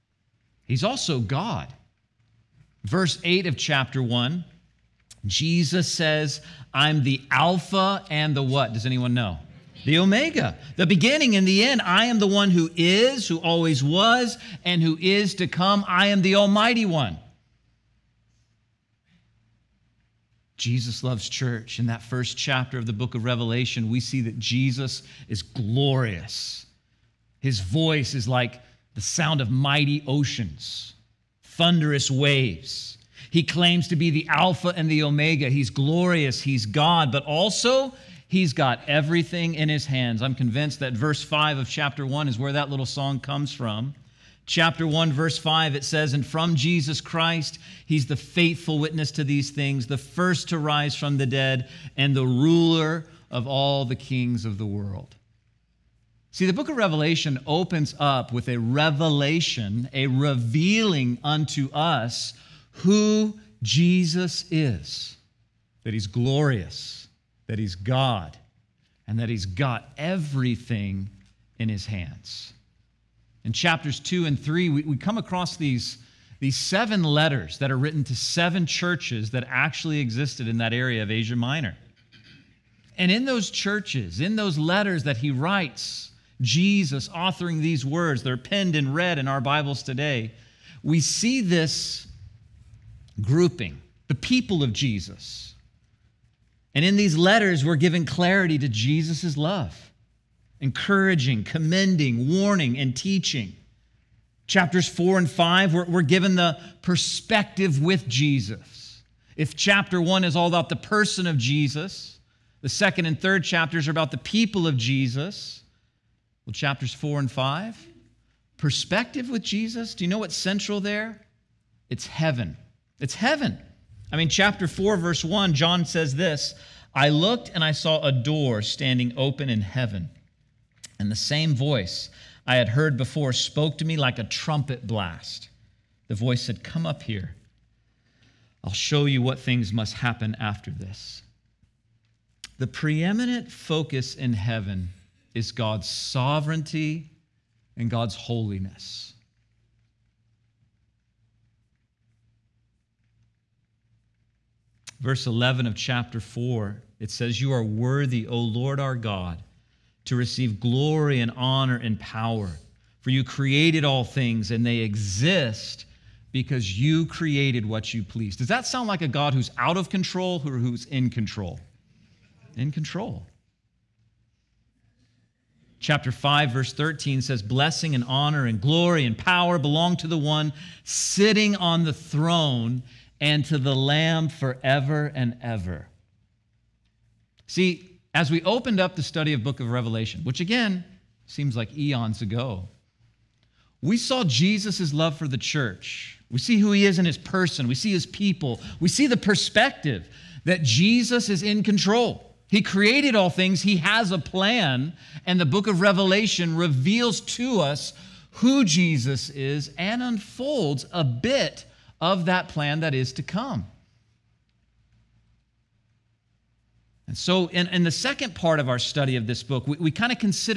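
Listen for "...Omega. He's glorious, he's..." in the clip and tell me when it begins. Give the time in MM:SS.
00:35.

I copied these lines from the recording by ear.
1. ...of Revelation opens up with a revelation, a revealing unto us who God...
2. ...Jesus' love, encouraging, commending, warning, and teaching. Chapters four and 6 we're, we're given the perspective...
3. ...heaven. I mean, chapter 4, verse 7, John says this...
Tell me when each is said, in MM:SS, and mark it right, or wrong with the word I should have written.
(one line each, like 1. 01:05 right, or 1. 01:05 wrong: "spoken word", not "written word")
1. 00:56 wrong: "Jesus", not "God"
2. 01:38 wrong: "5", not "6"
3. 02:03 wrong: "1", not "7".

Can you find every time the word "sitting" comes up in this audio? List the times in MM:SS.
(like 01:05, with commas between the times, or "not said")
03:00.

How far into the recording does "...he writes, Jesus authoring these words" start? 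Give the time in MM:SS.
01:25.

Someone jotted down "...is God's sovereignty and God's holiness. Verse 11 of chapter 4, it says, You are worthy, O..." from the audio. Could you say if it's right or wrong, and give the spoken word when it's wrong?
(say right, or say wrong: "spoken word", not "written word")
right.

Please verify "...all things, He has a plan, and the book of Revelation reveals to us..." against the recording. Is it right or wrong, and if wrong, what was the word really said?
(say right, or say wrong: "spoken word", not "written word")
right.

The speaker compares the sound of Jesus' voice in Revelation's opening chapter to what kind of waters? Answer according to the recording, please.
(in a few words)
Mighty oceans.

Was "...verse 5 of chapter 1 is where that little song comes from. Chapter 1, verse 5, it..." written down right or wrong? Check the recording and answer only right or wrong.
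right.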